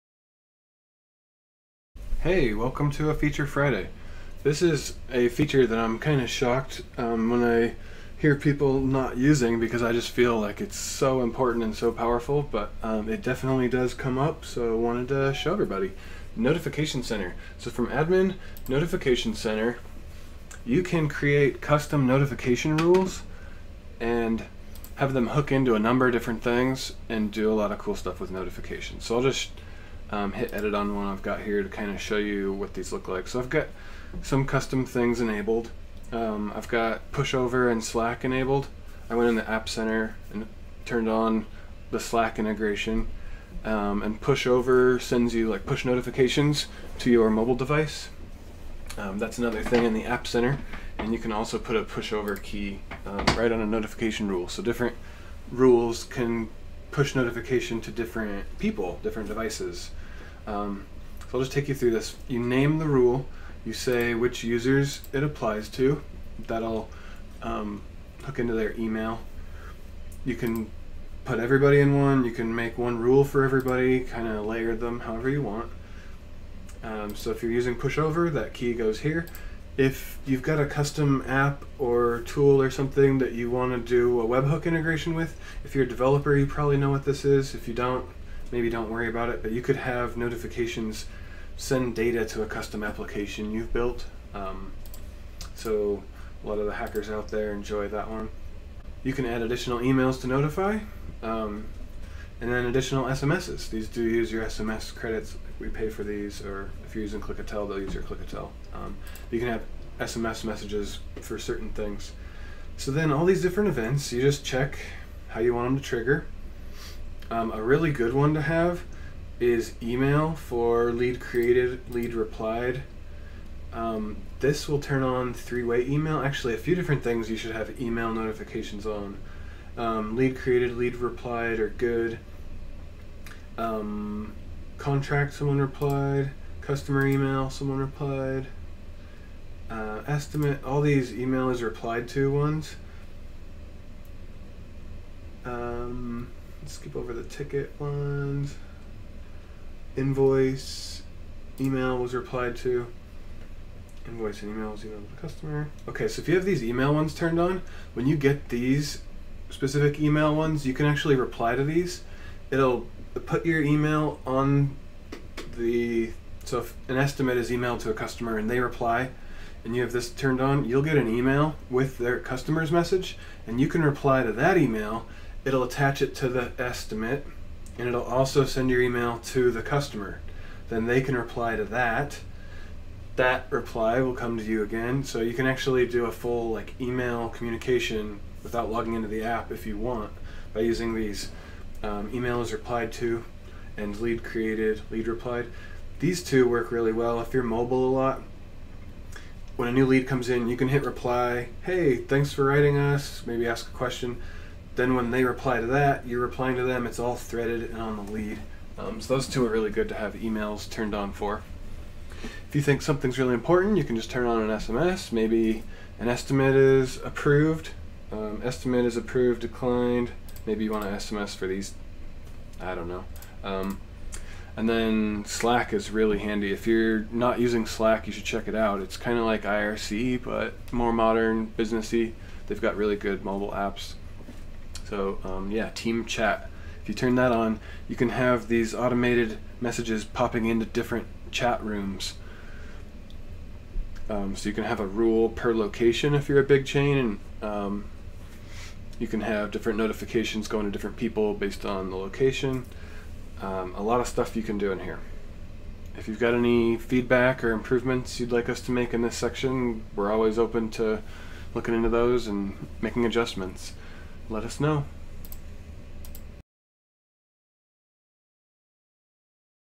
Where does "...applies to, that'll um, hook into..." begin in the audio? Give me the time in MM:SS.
01:05.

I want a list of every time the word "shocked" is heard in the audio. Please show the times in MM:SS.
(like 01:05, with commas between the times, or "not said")
00:06.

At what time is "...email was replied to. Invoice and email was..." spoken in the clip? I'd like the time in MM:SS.
02:31.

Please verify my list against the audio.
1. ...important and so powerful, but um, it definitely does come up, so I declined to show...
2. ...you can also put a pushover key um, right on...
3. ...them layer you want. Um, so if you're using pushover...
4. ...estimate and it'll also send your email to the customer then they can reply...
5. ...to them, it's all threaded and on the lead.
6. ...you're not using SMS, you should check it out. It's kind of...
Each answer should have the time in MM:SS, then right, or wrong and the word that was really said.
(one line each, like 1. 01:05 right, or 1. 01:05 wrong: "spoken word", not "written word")
1. 00:11 wrong: "wanted", not "declined"
2. 00:51 right
3. 01:14 wrong: "however", not "layer"
4. 02:56 right
5. 03:26 right
6. 03:46 wrong: "Slack", not "SMS".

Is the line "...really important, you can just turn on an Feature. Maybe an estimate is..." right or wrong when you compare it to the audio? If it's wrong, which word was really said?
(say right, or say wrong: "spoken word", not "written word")
wrong: "SMS", not "Feature".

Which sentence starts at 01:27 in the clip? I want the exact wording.
If you don't, maybe don't worry about it, but you could have notifications send data to a custom application you've built.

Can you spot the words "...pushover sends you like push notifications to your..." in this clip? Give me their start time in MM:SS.
00:44.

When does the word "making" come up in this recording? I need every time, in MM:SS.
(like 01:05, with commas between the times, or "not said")
04:22.